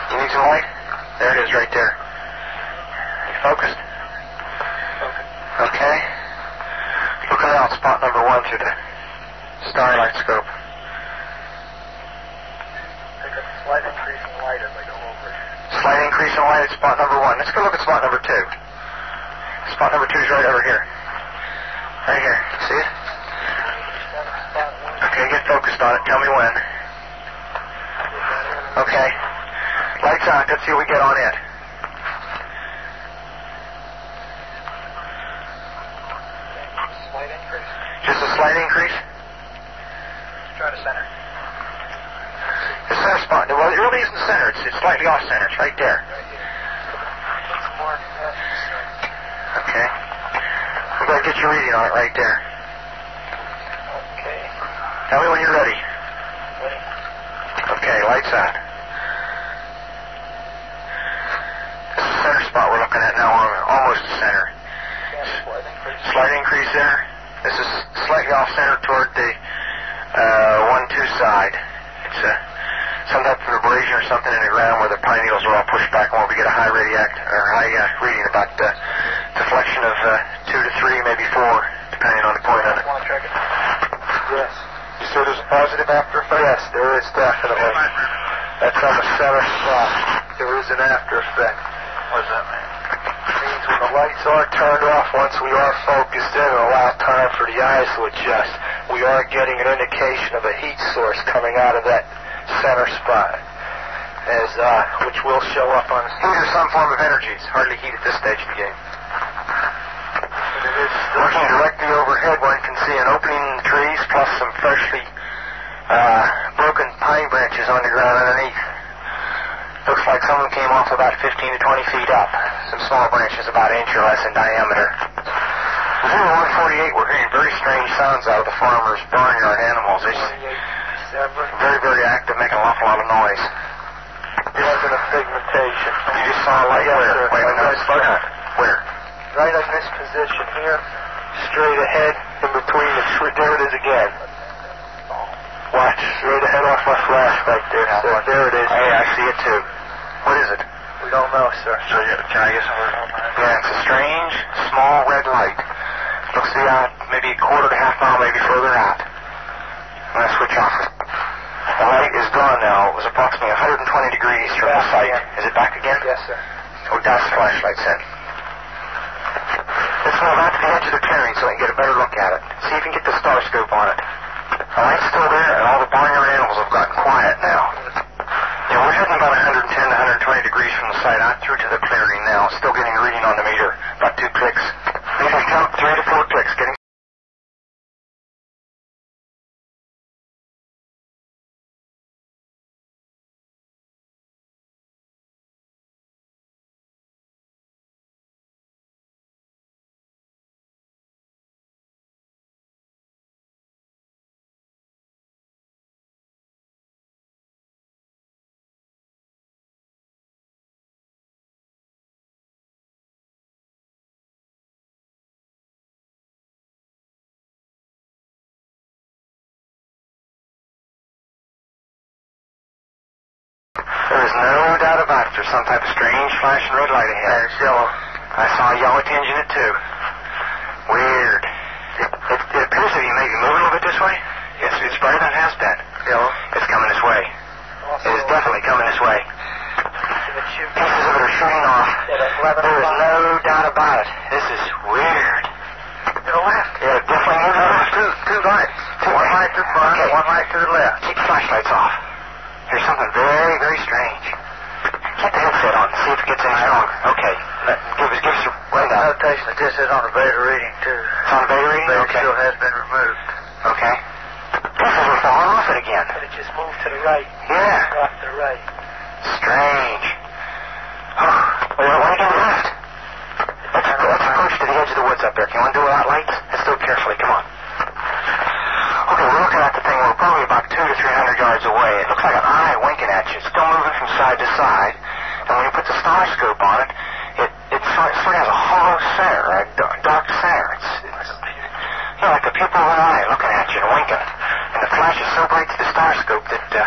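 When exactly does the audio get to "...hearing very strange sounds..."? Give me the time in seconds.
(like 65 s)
127 s.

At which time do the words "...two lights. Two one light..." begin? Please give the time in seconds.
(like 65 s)
248 s.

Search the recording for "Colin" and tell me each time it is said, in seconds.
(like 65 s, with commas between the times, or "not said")
not said.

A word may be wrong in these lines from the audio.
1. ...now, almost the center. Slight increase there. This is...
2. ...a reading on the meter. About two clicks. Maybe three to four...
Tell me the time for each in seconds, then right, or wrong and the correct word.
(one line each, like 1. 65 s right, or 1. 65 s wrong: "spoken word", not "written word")
1. 63 s right
2. 182 s right.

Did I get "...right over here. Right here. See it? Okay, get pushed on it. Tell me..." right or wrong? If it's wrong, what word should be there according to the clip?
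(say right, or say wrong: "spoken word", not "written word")
wrong: "focused", not "pushed".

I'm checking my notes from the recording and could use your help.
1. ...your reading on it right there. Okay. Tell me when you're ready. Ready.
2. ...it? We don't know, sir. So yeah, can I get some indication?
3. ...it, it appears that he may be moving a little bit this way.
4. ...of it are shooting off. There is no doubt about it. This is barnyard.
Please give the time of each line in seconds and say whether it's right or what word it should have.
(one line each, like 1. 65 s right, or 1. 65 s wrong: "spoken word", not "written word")
1. 51 s right
2. 150 s wrong: "version", not "indication"
3. 232 s right
4. 241 s wrong: "weird", not "barnyard".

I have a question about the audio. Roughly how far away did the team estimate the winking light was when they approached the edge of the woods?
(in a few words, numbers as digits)
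200 to 300 yards.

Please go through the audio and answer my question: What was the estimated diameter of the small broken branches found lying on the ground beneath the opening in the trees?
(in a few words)
an inch or less.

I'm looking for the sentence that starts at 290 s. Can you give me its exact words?
It's, it's you know, like a pupil of an eye looking at you and winking.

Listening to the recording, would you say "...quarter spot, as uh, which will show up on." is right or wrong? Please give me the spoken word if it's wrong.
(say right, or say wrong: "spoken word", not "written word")
wrong: "center", not "quarter".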